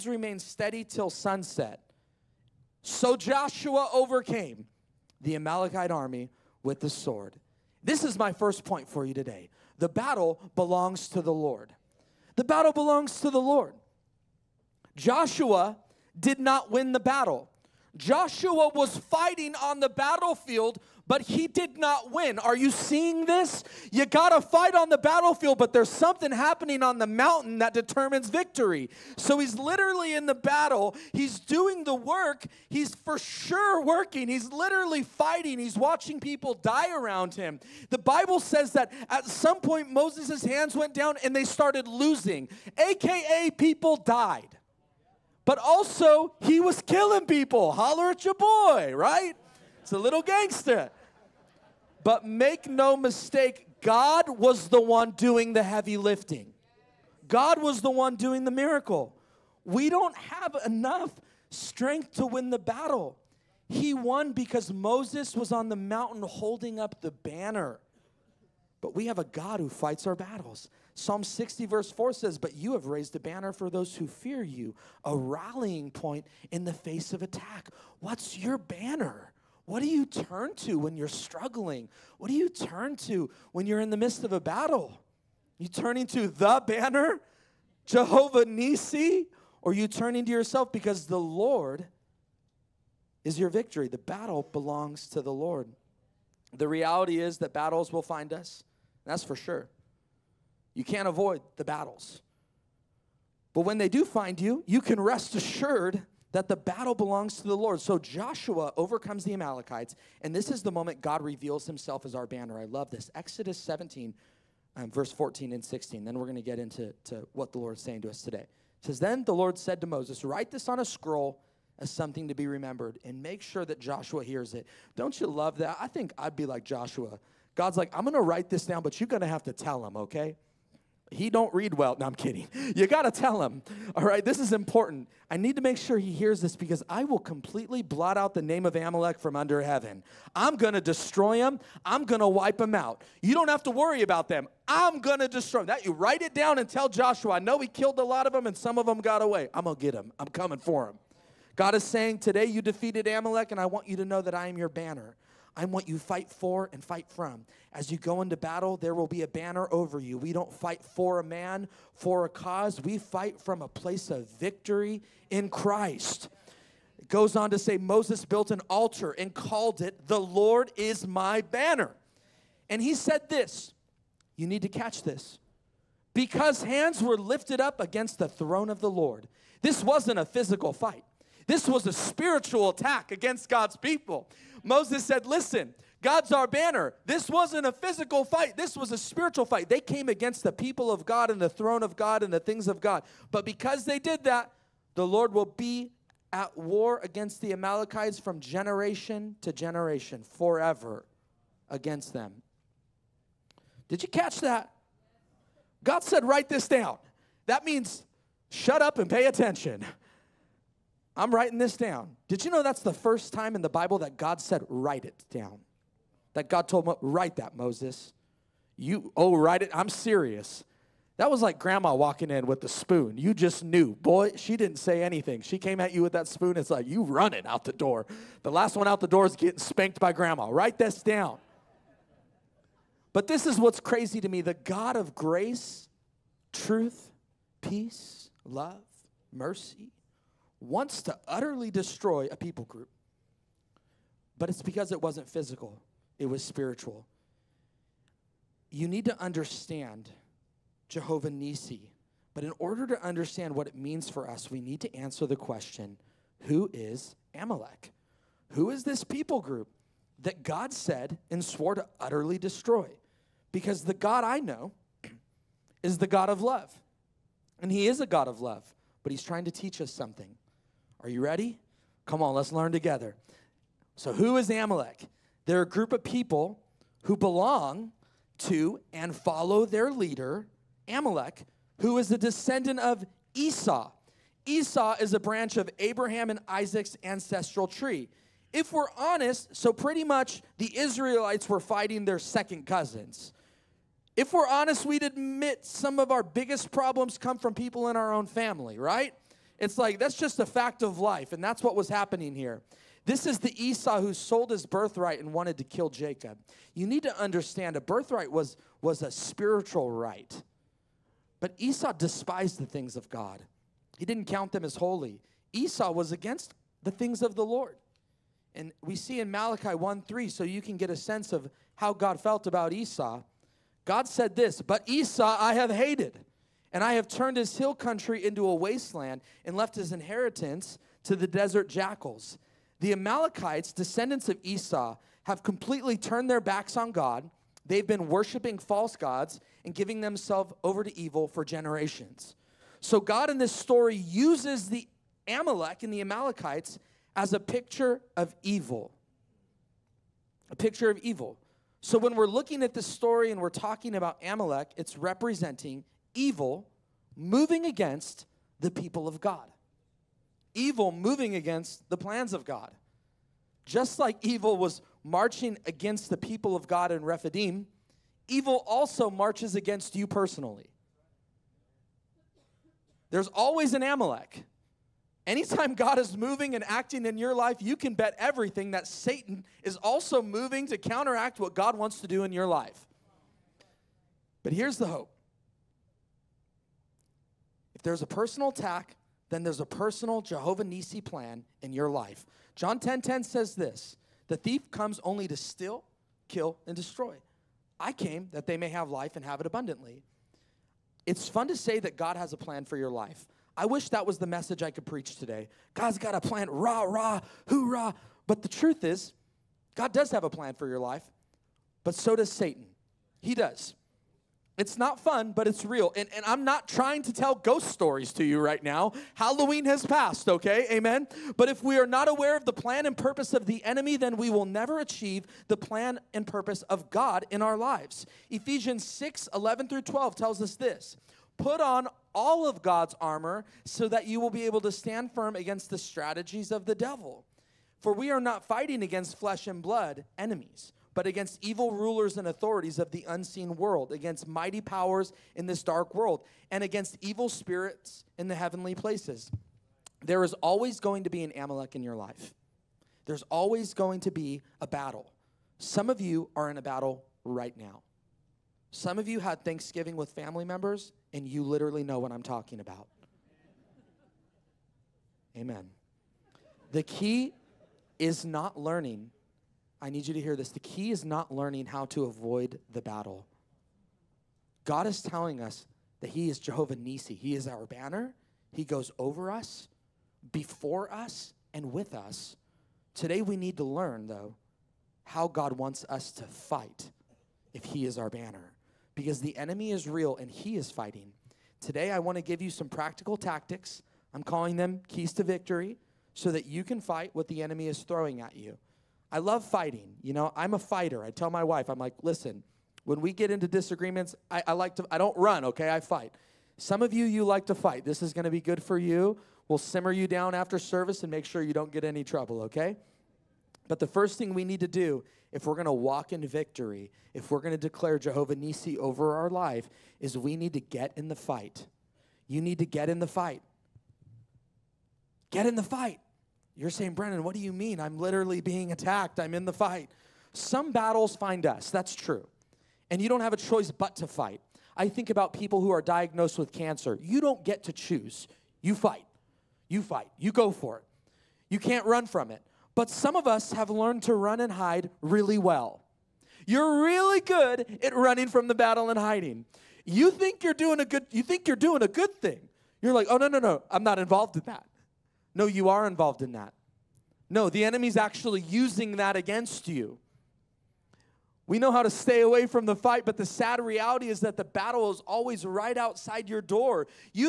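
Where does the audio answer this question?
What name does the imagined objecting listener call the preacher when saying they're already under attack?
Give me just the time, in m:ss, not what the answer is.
8:46.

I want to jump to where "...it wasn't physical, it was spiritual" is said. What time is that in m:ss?
4:04.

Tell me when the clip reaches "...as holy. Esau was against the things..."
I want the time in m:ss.
5:14.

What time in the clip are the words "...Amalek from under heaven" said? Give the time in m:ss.
2:18.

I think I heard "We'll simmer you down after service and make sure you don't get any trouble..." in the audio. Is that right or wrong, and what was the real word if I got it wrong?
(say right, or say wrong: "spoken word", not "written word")
right.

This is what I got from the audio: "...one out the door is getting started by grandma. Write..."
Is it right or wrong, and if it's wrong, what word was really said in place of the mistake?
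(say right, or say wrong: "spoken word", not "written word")
wrong: "spanked", not "started".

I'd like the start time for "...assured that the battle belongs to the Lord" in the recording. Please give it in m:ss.
1:45.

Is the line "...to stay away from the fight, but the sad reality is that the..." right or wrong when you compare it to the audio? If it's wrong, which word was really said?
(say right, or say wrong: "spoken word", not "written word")
right.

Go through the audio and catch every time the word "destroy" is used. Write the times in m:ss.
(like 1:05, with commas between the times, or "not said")
2:20, 2:25, 4:01, 4:22, 6:36.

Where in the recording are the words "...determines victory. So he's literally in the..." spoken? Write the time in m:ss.
0:27.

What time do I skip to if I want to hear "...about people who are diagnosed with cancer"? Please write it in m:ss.
8:55.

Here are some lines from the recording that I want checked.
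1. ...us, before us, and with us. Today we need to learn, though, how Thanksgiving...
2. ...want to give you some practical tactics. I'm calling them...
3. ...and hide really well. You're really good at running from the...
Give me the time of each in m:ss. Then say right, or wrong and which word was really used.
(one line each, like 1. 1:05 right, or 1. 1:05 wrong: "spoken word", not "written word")
1. 7:59 wrong: "God", not "Thanksgiving"
2. 8:11 right
3. 9:04 right.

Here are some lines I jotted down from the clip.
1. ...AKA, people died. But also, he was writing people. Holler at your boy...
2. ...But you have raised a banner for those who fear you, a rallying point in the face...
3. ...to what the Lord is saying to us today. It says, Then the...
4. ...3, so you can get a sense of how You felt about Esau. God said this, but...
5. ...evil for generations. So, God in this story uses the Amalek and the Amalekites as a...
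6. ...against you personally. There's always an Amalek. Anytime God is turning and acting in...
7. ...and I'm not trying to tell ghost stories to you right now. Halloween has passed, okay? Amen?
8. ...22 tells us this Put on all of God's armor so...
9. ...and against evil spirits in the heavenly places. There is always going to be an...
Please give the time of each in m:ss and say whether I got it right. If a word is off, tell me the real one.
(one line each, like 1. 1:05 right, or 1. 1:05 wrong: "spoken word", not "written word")
1. 0:42 wrong: "killing", not "writing"
2. 1:12 right
3. 1:57 right
4. 5:20 wrong: "God", not "You"
5. 5:40 right
6. 6:09 wrong: "moving", not "turning"
7. 6:56 right
8. 7:09 wrong: "12", not "22"
9. 7:26 right.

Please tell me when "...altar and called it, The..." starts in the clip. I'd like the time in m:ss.
2:48.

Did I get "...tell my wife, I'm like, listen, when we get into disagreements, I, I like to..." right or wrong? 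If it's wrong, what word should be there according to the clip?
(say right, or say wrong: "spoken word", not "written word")
right.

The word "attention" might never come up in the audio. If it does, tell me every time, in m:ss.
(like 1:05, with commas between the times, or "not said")
3:29.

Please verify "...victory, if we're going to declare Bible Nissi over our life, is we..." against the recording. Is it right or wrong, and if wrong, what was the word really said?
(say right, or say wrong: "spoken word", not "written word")
wrong: "Jehovah", not "Bible".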